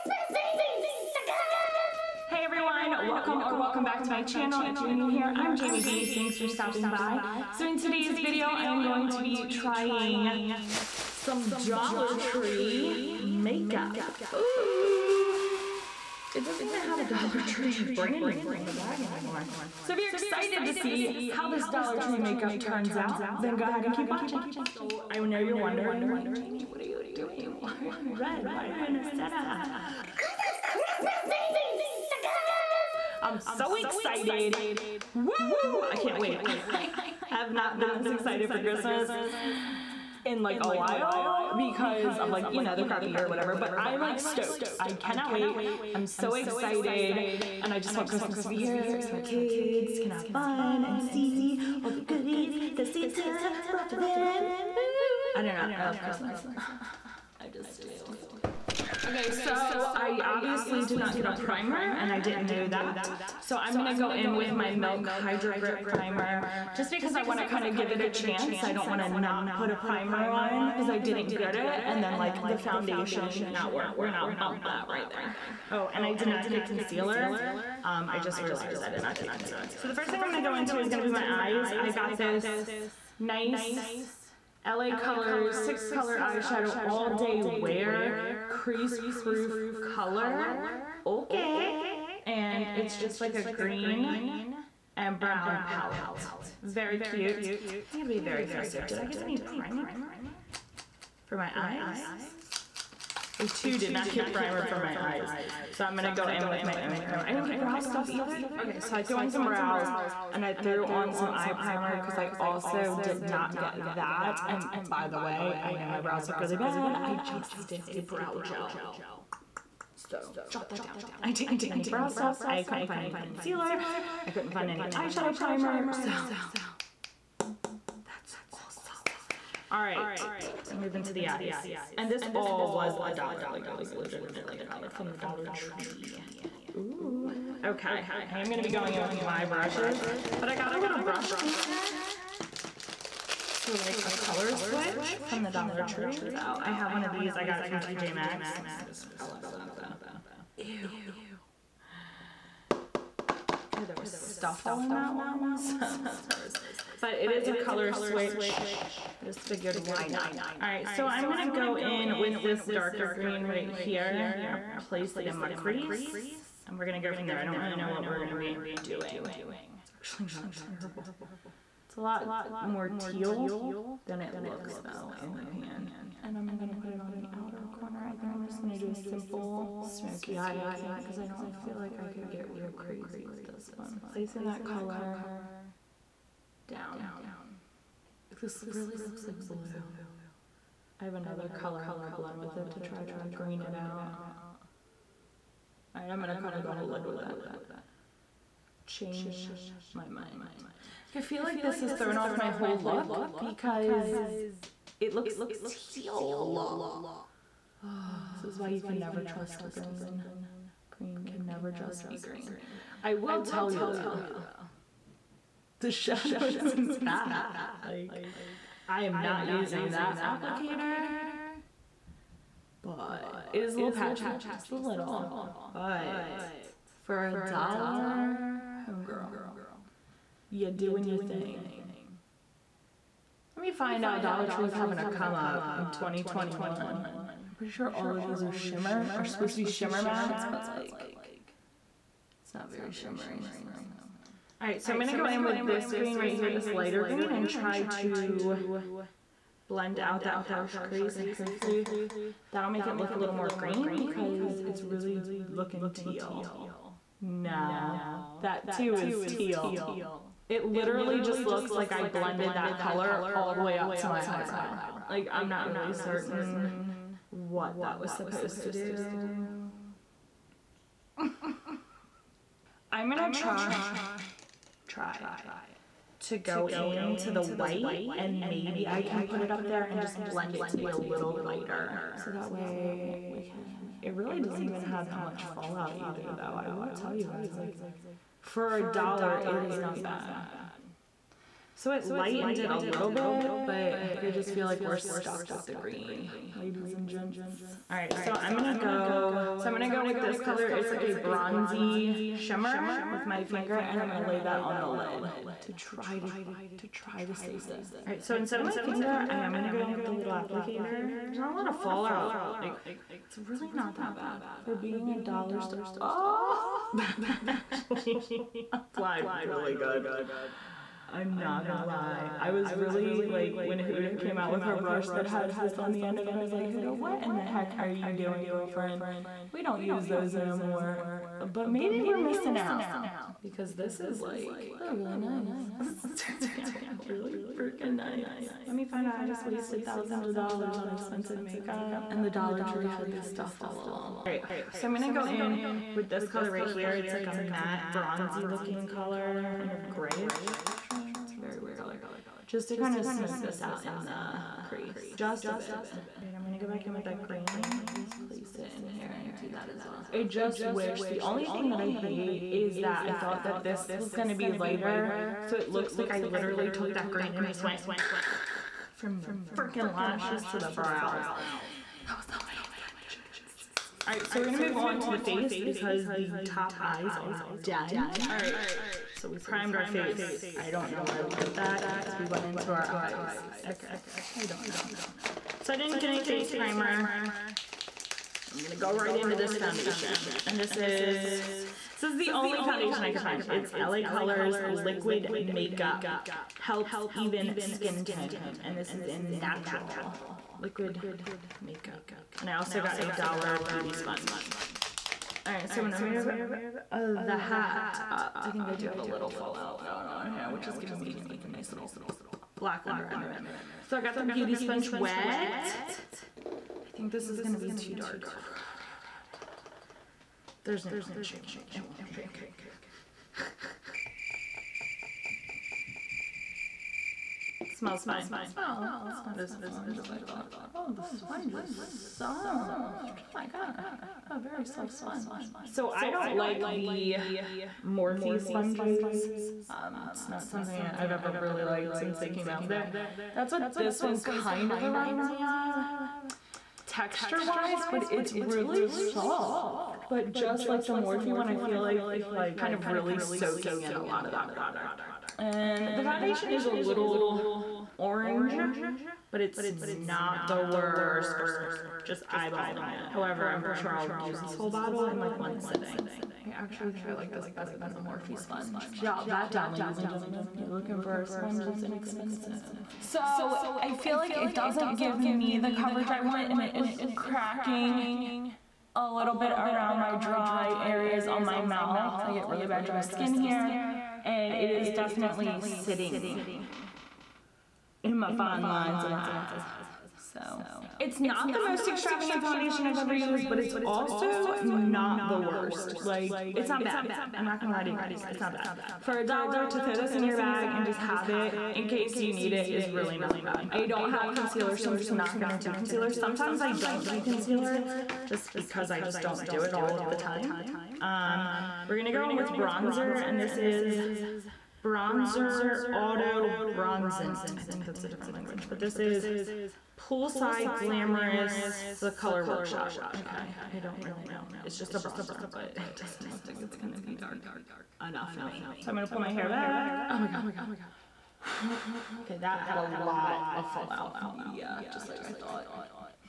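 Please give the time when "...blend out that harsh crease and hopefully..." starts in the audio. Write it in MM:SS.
04:09.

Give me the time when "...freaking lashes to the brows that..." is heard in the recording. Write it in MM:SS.
06:09.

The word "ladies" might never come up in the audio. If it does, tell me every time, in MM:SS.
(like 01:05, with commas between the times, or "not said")
04:56, 07:49.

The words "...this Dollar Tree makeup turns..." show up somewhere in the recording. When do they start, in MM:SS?
00:21.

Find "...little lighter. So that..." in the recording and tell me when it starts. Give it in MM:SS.
04:40.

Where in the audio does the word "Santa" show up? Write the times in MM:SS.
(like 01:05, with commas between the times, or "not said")
00:29, 00:52.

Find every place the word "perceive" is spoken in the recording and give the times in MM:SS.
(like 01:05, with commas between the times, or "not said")
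not said.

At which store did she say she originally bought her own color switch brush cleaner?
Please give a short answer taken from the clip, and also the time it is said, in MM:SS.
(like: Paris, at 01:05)
TJ Maxx, at 02:27.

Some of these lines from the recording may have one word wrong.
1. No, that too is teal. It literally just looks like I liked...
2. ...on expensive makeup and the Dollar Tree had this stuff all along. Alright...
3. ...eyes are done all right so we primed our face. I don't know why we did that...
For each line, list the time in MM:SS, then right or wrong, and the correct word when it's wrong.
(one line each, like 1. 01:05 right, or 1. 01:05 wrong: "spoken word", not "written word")
1. 04:17 wrong: "blended", not "liked"
2. 05:40 right
3. 06:16 right.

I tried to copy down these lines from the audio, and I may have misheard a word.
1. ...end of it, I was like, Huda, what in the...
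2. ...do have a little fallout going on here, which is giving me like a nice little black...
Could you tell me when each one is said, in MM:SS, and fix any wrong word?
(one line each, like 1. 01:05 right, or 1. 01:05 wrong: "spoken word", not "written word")
1. 05:26 right
2. 06:48 right.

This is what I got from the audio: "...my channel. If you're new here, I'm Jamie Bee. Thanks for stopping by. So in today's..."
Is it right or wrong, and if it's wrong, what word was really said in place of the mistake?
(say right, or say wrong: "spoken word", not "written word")
right.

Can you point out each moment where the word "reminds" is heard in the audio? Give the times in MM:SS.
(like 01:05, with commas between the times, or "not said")
07:24.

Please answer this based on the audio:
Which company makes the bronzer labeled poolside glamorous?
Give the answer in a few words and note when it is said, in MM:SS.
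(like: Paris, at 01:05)
The Color Workshop, at 08:41.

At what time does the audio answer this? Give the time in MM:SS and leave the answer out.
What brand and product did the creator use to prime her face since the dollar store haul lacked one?
01:04.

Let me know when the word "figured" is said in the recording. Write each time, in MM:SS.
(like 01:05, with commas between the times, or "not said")
02:39.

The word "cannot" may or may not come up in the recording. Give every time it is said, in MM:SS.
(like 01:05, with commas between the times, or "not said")
00:44.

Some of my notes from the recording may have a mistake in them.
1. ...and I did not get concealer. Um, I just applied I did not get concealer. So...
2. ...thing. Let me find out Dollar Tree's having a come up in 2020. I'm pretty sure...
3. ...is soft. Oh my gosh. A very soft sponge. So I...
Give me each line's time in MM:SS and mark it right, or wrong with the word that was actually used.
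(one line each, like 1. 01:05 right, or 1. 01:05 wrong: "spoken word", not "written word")
1. 01:15 wrong: "realized", not "applied"
2. 03:51 wrong: "2021", not "2020"
3. 07:11 right.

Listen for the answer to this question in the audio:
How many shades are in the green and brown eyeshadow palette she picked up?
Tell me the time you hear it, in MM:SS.
01:25.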